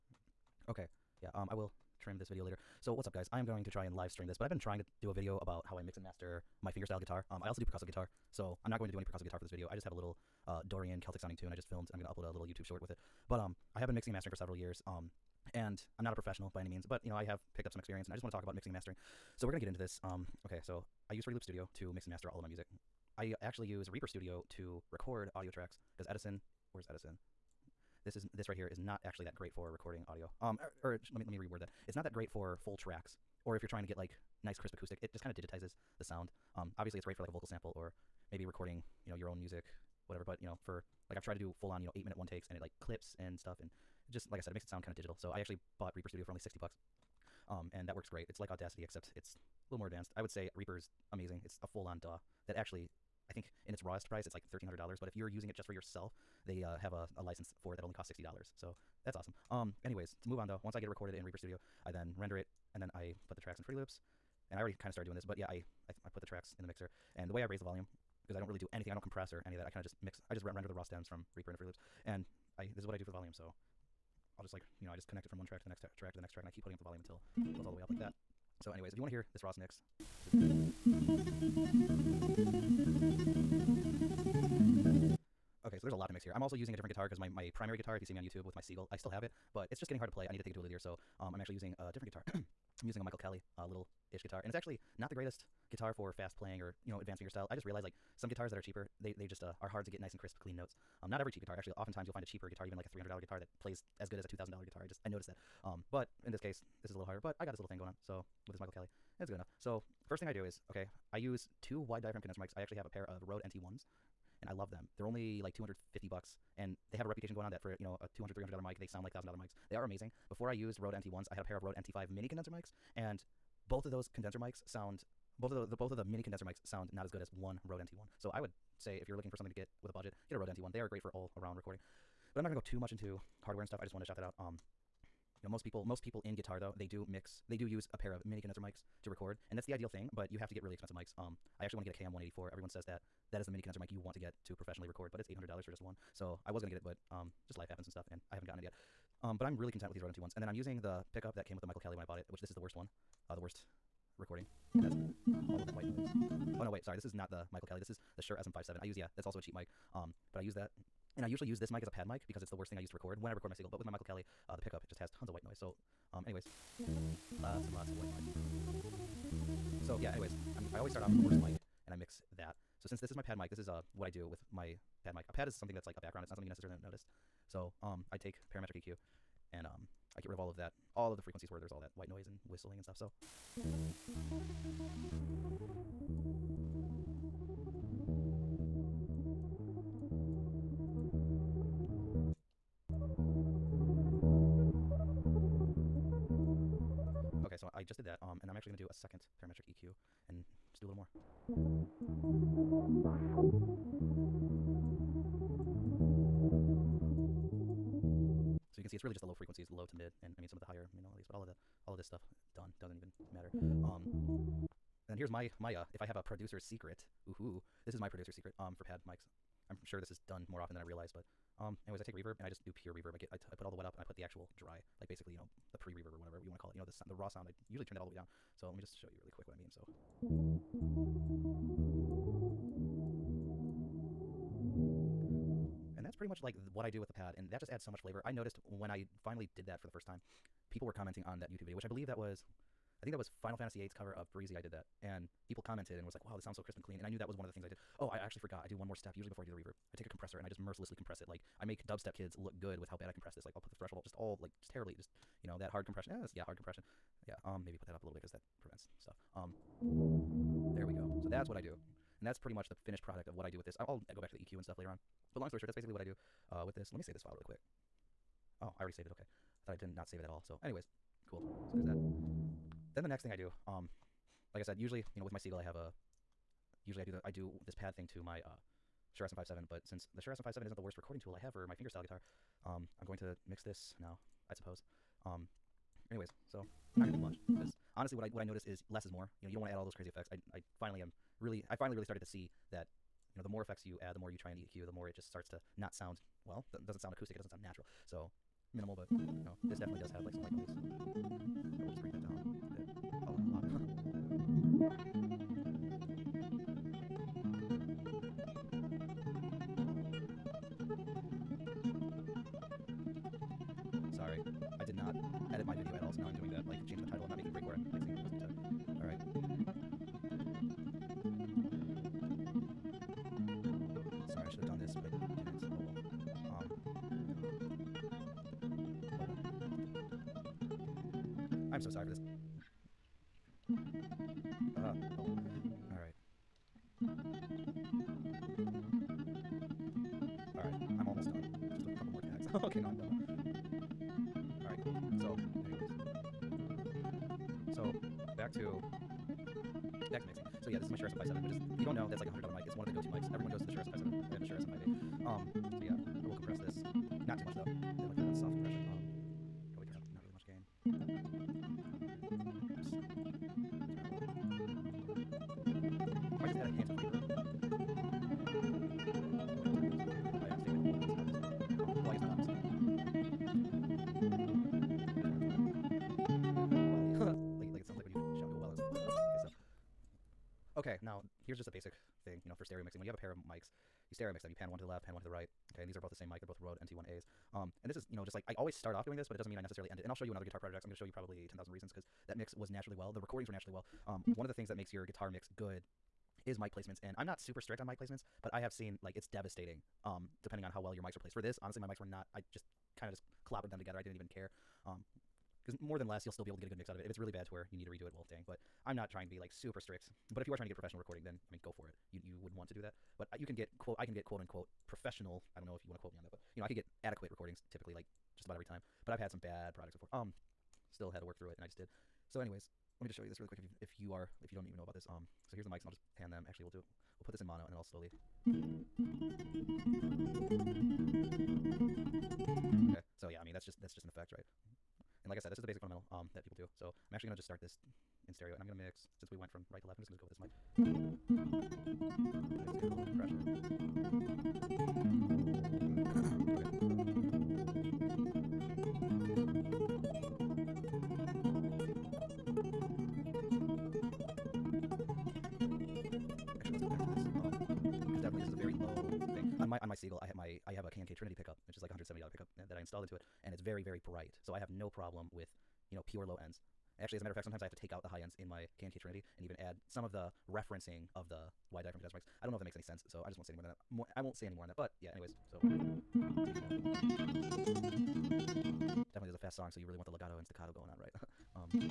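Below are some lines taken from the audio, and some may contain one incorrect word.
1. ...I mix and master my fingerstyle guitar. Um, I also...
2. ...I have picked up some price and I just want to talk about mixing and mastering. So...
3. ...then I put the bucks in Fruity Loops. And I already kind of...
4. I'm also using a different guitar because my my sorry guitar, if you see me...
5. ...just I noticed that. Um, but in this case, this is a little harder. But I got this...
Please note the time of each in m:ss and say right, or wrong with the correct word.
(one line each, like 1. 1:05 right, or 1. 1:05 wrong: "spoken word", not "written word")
1. 0:05 right
2. 0:17 wrong: "experience", not "price"
3. 1:02 wrong: "tracks", not "bucks"
4. 1:26 wrong: "primary", not "sorry"
5. 1:44 right.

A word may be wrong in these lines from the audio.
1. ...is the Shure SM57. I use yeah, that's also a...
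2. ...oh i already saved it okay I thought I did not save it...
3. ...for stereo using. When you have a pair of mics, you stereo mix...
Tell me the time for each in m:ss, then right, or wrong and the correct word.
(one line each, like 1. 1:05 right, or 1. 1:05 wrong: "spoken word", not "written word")
1. 2:37 right
2. 4:28 right
3. 6:22 wrong: "mixing", not "using".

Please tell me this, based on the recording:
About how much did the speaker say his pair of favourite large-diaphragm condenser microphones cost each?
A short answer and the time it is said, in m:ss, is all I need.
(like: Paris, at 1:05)
$250, at 1:55.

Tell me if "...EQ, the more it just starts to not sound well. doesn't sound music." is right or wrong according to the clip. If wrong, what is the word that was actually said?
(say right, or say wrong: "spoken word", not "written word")
wrong: "acoustic", not "music".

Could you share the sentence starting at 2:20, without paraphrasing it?
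But you have to get really expensive mics.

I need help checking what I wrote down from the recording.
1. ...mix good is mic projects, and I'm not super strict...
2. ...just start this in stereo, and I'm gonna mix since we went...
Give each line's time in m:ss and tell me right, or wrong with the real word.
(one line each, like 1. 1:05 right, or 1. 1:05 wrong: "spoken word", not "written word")
1. 6:35 wrong: "placements", not "projects"
2. 7:17 right.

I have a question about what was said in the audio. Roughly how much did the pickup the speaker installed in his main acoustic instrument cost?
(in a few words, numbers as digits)
$170.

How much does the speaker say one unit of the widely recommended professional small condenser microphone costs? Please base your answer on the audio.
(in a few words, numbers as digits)
$800.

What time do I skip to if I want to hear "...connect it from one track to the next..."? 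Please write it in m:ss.
1:15.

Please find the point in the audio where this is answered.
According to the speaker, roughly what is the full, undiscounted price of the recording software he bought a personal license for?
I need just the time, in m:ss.
0:54.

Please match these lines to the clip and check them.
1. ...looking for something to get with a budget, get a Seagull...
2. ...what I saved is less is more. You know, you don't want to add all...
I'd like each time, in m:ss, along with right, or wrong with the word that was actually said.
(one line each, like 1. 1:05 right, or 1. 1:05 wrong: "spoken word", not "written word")
1. 2:09 wrong: "Rode", not "Seagull"
2. 4:48 wrong: "noticed", not "saved".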